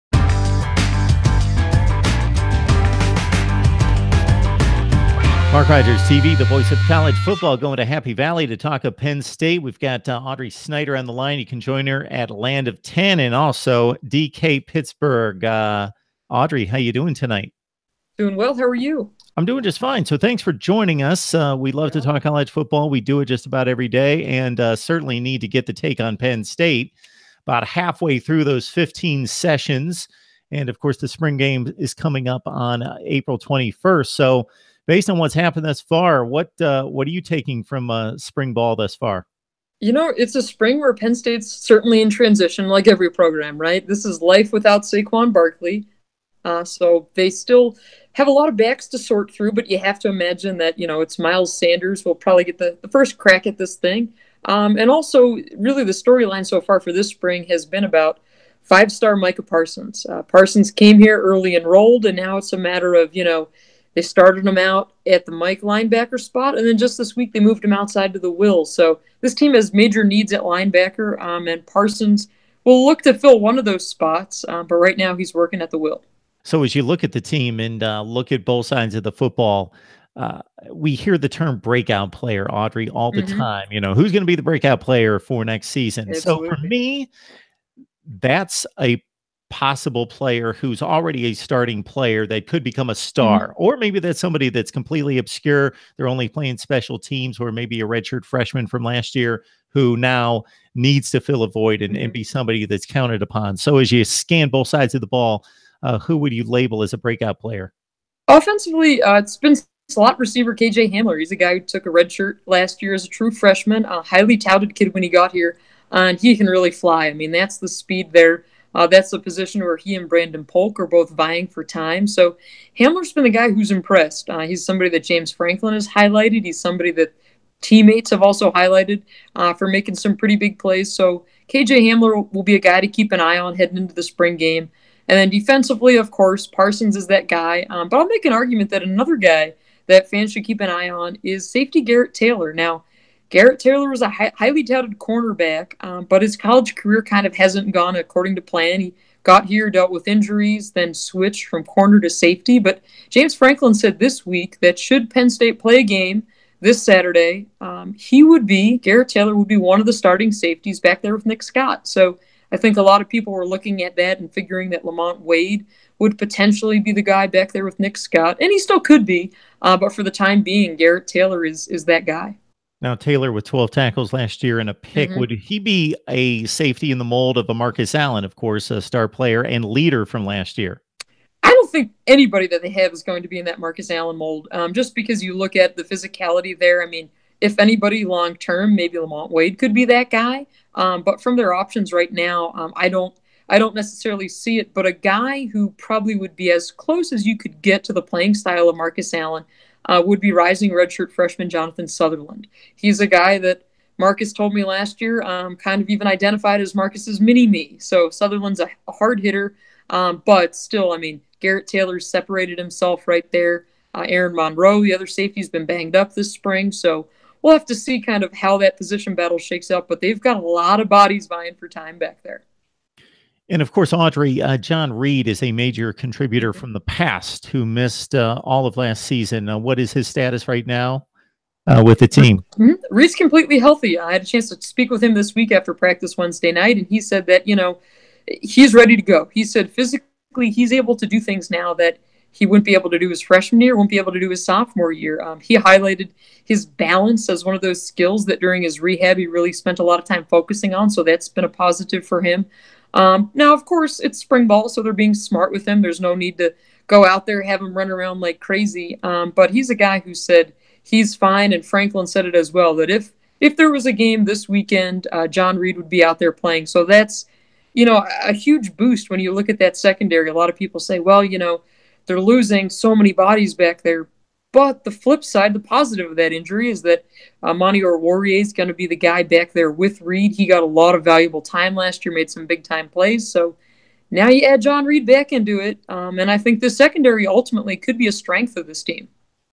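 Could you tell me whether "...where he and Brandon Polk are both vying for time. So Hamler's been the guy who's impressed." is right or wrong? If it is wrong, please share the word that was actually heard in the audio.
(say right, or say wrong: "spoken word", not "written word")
right.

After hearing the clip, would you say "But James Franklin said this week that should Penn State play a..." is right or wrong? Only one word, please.
right.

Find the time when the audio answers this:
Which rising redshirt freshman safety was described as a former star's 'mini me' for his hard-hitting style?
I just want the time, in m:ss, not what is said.
3:21.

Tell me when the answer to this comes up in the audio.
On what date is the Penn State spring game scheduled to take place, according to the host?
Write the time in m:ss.
0:33.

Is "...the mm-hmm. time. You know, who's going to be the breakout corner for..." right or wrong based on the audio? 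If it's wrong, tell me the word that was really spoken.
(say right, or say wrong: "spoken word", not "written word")
wrong: "player", not "corner".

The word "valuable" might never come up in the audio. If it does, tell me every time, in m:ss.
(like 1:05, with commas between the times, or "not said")
4:41.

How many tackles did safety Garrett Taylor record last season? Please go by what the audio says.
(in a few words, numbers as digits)
12.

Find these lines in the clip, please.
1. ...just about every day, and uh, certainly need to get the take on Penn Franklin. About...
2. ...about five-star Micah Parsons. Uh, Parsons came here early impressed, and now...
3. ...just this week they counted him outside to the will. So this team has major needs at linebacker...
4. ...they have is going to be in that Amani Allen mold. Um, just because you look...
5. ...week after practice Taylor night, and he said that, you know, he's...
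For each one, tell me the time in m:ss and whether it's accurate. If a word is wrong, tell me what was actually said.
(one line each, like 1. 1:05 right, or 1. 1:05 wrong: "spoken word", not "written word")
1. 0:23 wrong: "State", not "Franklin"
2. 0:57 wrong: "enrolled", not "impressed"
3. 1:06 wrong: "moved", not "counted"
4. 3:02 wrong: "Marcus", not "Amani"
5. 3:55 wrong: "Wednesday", not "Taylor".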